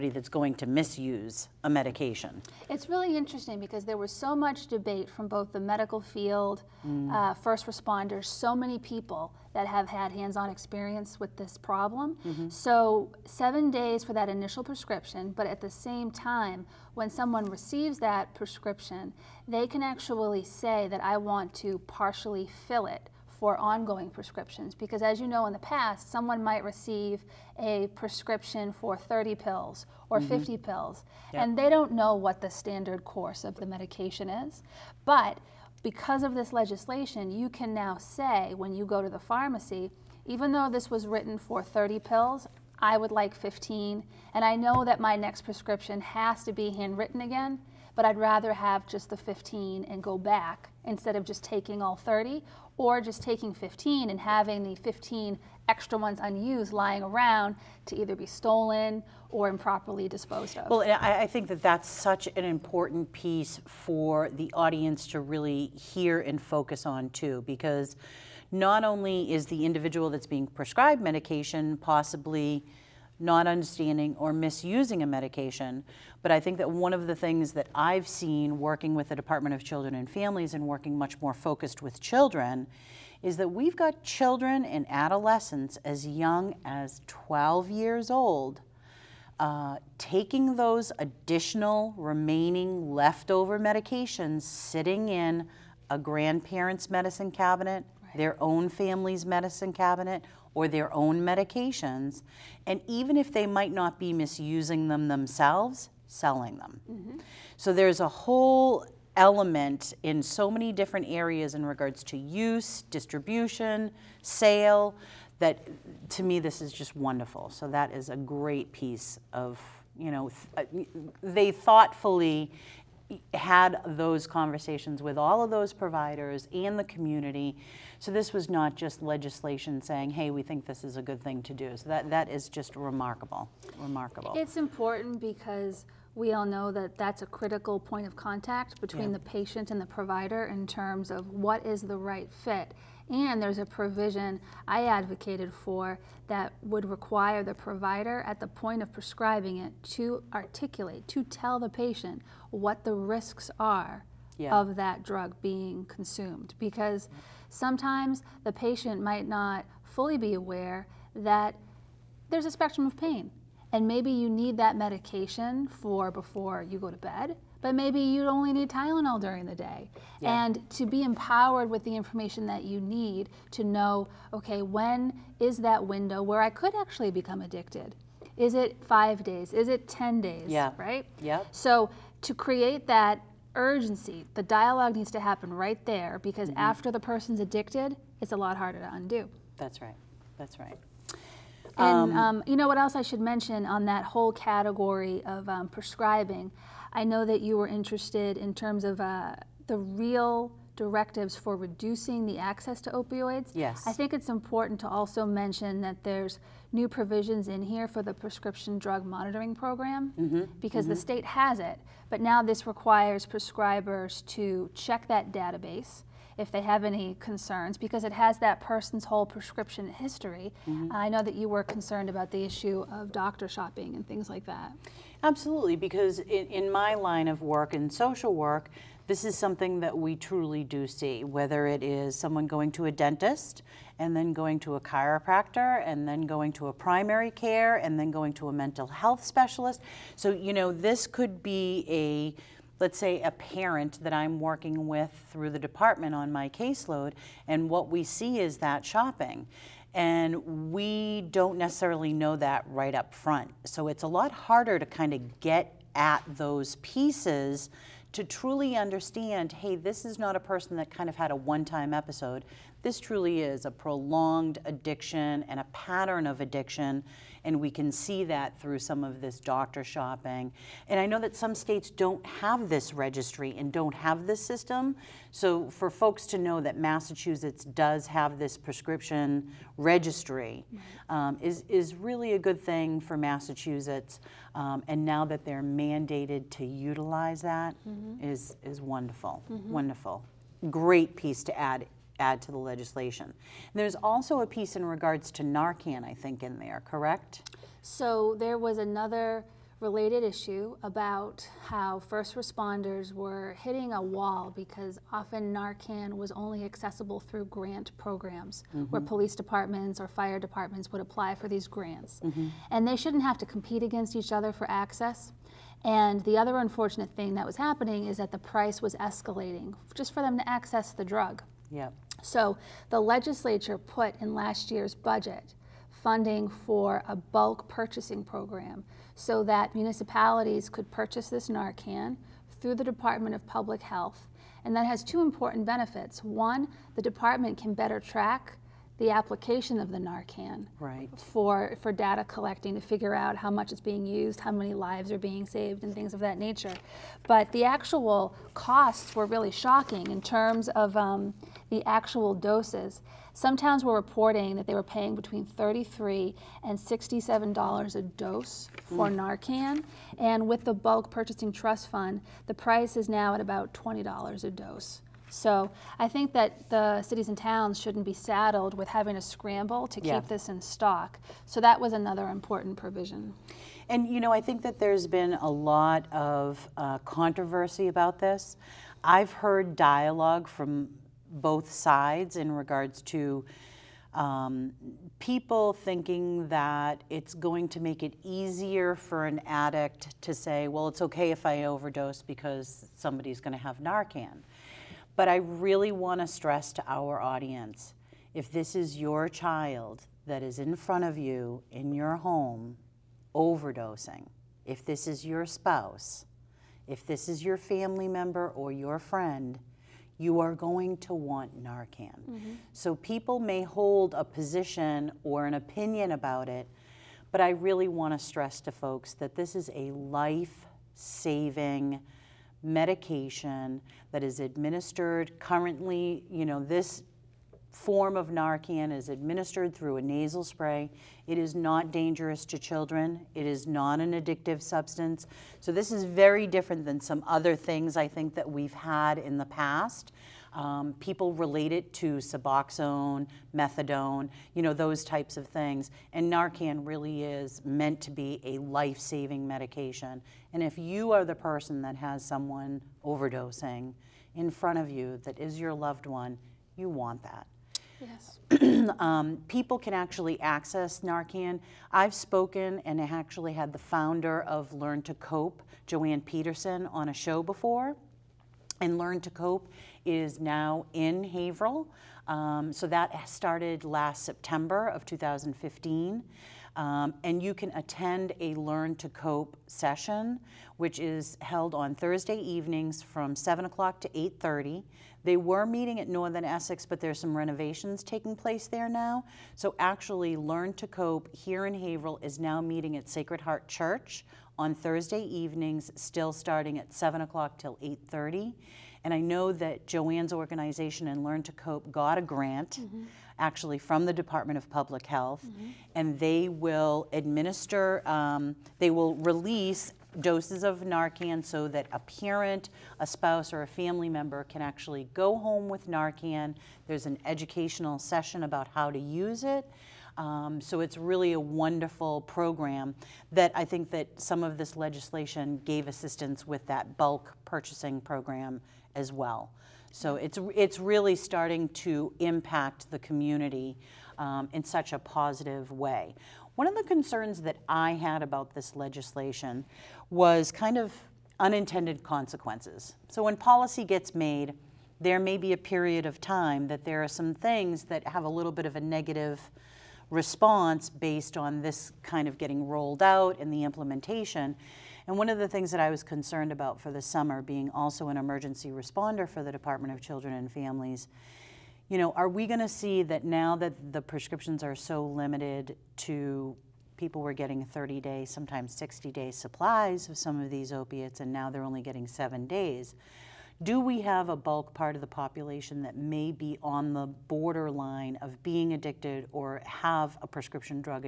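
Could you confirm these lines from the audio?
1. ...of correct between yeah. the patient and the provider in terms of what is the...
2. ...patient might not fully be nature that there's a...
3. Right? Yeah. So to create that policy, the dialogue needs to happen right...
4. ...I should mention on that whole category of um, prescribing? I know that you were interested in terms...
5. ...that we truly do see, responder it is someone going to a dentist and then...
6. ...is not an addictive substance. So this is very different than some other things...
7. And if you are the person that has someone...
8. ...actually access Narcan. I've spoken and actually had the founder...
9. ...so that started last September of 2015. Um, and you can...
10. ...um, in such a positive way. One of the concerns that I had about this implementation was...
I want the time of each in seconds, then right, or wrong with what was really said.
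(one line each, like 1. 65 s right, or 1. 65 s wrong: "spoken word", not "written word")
1. 138 s wrong: "contact", not "correct"
2. 158 s wrong: "aware", not "nature"
3. 180 s wrong: "urgency", not "policy"
4. 192 s right
5. 229 s wrong: "whether", not "responder"
6. 433 s right
7. 450 s right
8. 459 s right
9. 472 s right
10. 534 s wrong: "legislation", not "implementation".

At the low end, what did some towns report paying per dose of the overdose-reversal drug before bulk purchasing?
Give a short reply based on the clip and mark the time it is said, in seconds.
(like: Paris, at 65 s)
$33, at 355 s.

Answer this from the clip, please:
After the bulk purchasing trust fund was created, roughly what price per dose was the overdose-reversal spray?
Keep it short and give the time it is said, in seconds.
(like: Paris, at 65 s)
$20, at 363 s.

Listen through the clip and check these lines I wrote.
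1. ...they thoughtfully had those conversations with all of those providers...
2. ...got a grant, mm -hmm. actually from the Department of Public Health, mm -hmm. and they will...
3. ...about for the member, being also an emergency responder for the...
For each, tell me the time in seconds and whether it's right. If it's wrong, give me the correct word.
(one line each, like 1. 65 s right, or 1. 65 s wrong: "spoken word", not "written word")
1. 121 s right
2. 501 s right
3. 556 s wrong: "summer", not "member".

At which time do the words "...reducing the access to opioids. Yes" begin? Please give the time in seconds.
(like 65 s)
201 s.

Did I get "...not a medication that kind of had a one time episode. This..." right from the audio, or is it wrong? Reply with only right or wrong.
wrong.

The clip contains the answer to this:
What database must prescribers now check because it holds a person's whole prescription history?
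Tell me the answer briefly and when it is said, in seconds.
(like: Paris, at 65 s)
prescription drug monitoring program, at 208 s.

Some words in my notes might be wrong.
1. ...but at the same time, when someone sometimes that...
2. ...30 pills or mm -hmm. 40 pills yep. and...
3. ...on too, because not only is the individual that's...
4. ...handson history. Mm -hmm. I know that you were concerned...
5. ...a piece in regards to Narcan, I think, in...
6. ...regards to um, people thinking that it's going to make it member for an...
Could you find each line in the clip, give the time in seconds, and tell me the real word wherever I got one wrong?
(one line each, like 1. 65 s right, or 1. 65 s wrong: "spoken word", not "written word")
1. 15 s wrong: "receives", not "sometimes"
2. 28 s wrong: "50", not "40"
3. 66 s right
4. 219 s wrong: "prescription", not "handson"
5. 294 s right
6. 382 s wrong: "easier", not "member".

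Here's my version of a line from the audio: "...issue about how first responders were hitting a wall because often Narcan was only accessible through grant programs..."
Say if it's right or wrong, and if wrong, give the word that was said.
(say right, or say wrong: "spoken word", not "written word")
right.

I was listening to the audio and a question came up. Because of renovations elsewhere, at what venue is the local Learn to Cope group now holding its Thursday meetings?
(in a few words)
Sacred Heart Church.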